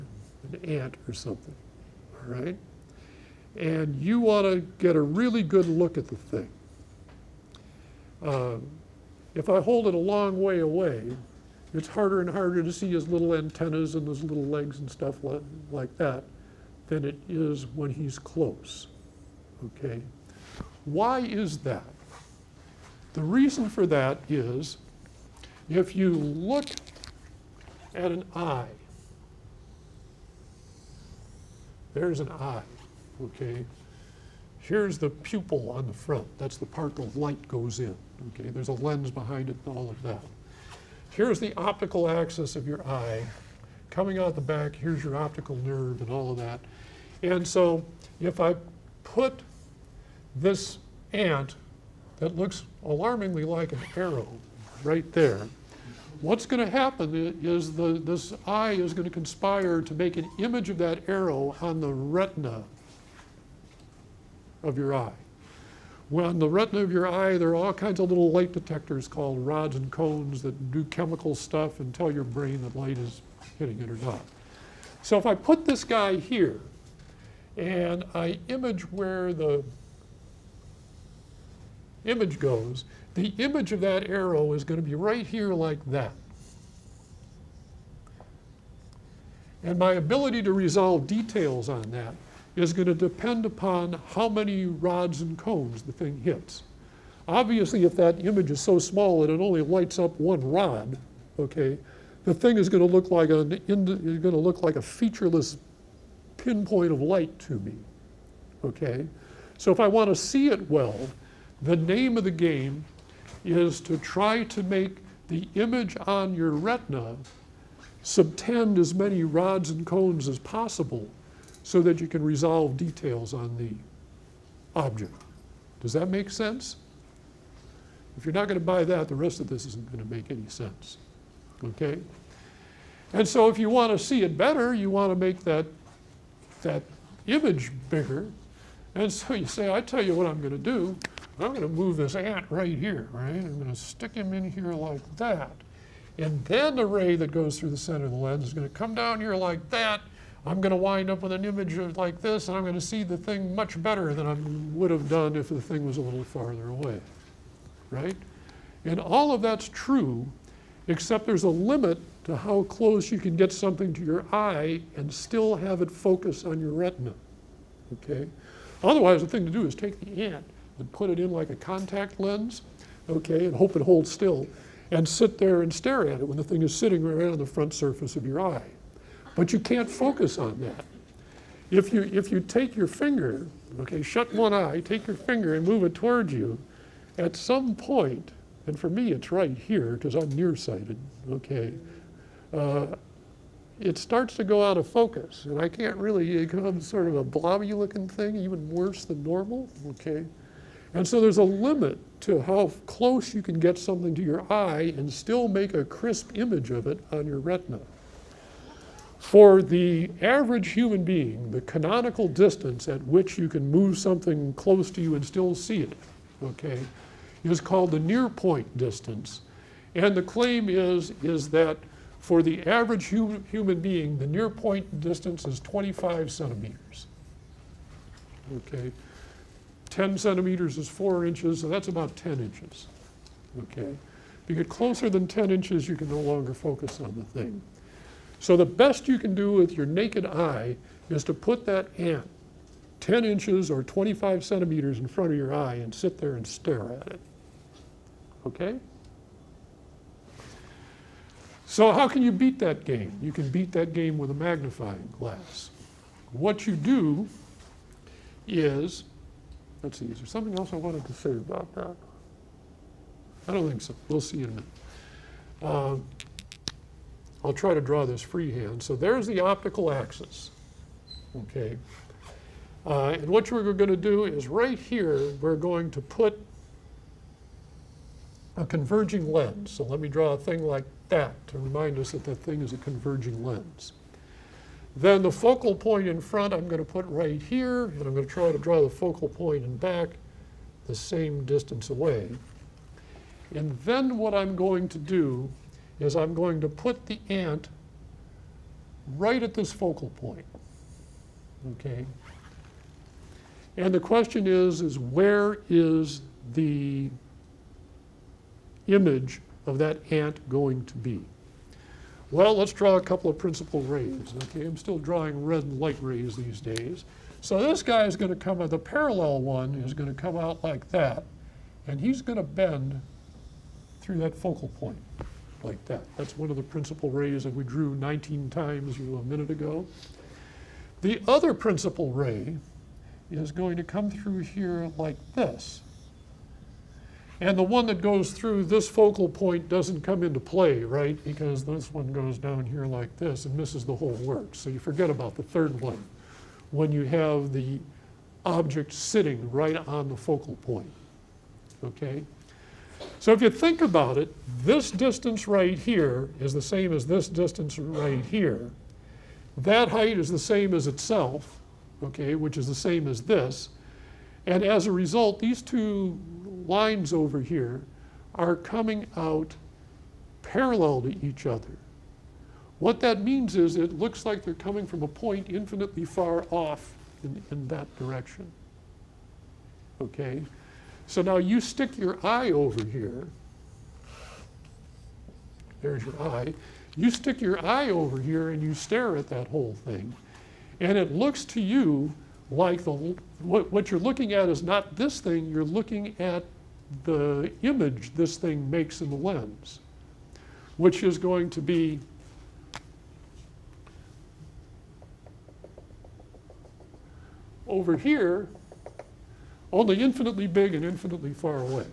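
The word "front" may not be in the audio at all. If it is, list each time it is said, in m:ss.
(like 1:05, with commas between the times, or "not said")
0:35, 2:57, 4:05, 4:46.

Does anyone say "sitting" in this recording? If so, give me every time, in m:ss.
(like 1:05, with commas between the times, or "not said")
2:56, 5:48.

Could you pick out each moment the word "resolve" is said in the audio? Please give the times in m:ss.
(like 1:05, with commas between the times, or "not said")
1:30, 2:02.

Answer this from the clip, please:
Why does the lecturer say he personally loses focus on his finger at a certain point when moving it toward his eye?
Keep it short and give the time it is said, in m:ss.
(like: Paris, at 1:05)
nearsighted, at 3:10.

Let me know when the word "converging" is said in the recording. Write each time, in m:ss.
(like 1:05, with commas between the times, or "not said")
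4:38, 4:42.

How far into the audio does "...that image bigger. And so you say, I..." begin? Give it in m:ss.
2:16.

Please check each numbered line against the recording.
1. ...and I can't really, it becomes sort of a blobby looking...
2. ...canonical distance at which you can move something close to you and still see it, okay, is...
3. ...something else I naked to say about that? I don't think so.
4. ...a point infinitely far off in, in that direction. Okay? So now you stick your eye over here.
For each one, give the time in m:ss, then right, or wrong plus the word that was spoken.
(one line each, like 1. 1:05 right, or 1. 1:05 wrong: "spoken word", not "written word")
1. 3:15 right
2. 3:31 right
3. 4:20 wrong: "wanted", not "naked"
4. 6:15 right.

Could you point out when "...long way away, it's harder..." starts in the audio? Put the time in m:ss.
0:09.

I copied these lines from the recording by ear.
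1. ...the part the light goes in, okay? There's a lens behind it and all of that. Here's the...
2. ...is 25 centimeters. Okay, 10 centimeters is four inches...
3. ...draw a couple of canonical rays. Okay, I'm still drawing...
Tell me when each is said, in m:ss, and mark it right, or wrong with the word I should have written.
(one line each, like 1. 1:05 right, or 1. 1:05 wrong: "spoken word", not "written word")
1. 0:36 right
2. 3:45 right
3. 5:12 wrong: "principal", not "canonical".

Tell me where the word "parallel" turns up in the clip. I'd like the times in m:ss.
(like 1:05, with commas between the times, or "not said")
5:18, 6:10.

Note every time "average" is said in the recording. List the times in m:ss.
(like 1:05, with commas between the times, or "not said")
3:30, 3:42.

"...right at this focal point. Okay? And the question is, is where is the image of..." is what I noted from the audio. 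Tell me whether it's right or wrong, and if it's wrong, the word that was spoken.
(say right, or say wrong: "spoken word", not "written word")
right.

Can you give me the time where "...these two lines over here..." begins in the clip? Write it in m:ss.
6:05.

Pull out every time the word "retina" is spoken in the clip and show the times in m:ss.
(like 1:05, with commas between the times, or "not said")
1:01, 1:06, 1:56, 2:46, 3:27.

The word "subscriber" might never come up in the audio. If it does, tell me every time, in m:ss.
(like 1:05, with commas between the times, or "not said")
not said.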